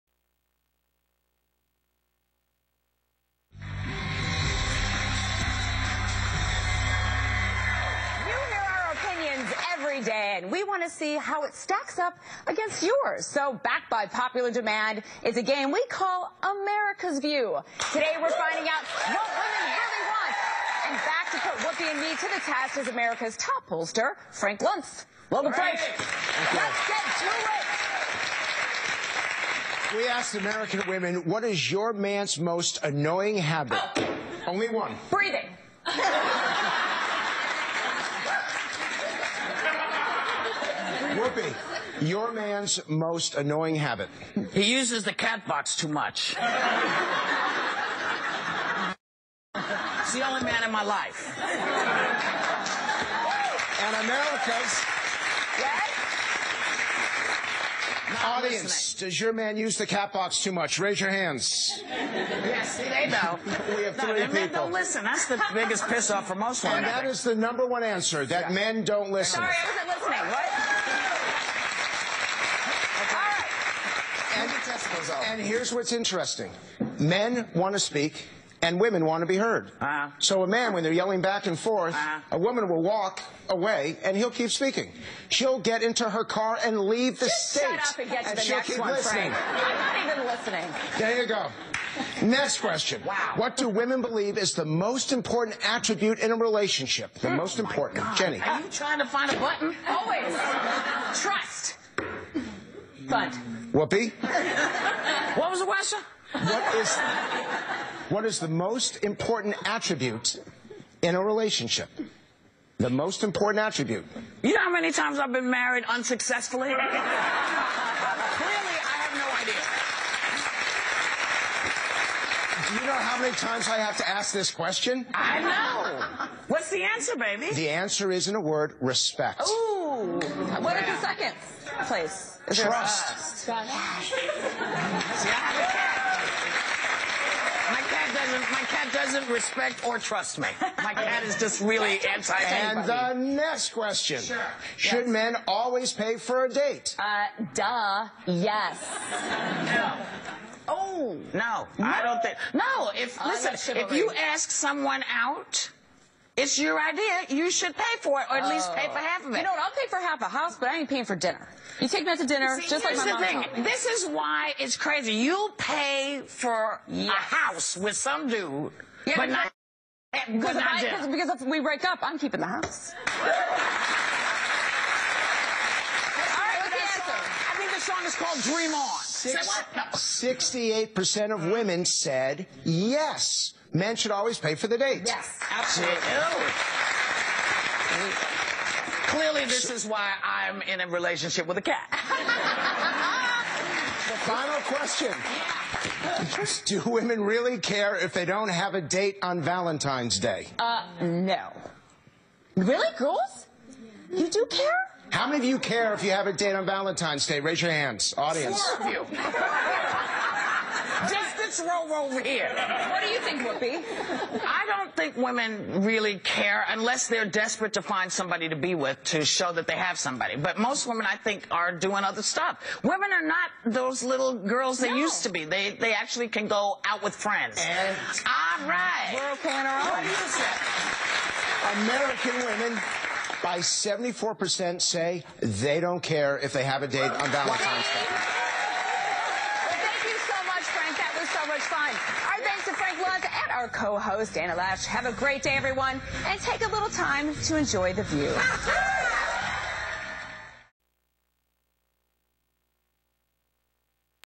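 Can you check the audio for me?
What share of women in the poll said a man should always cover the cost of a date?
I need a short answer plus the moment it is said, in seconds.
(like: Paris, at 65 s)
68 percent, at 180 s.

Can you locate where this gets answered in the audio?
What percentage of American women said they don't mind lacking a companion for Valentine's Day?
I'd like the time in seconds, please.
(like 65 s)
233 s.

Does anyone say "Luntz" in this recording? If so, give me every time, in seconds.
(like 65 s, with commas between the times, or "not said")
24 s, 243 s.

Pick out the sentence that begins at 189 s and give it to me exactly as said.
Clearly, this is why I'm in a relationship with a cat.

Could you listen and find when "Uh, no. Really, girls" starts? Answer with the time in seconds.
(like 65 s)
200 s.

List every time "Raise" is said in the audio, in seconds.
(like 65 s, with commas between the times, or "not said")
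60 s, 207 s.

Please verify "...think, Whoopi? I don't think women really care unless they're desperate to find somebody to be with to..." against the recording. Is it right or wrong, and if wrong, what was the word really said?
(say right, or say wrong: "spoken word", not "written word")
right.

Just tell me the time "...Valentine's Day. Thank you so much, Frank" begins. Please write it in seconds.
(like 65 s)
237 s.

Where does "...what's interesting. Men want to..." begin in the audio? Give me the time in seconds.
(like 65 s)
75 s.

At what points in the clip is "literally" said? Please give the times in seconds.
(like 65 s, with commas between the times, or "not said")
not said.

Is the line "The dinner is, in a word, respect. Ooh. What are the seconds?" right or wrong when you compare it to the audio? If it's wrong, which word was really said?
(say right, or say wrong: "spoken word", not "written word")
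wrong: "answer", not "dinner".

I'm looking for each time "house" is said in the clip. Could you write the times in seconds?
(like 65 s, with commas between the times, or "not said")
160 s, 167 s, 172 s.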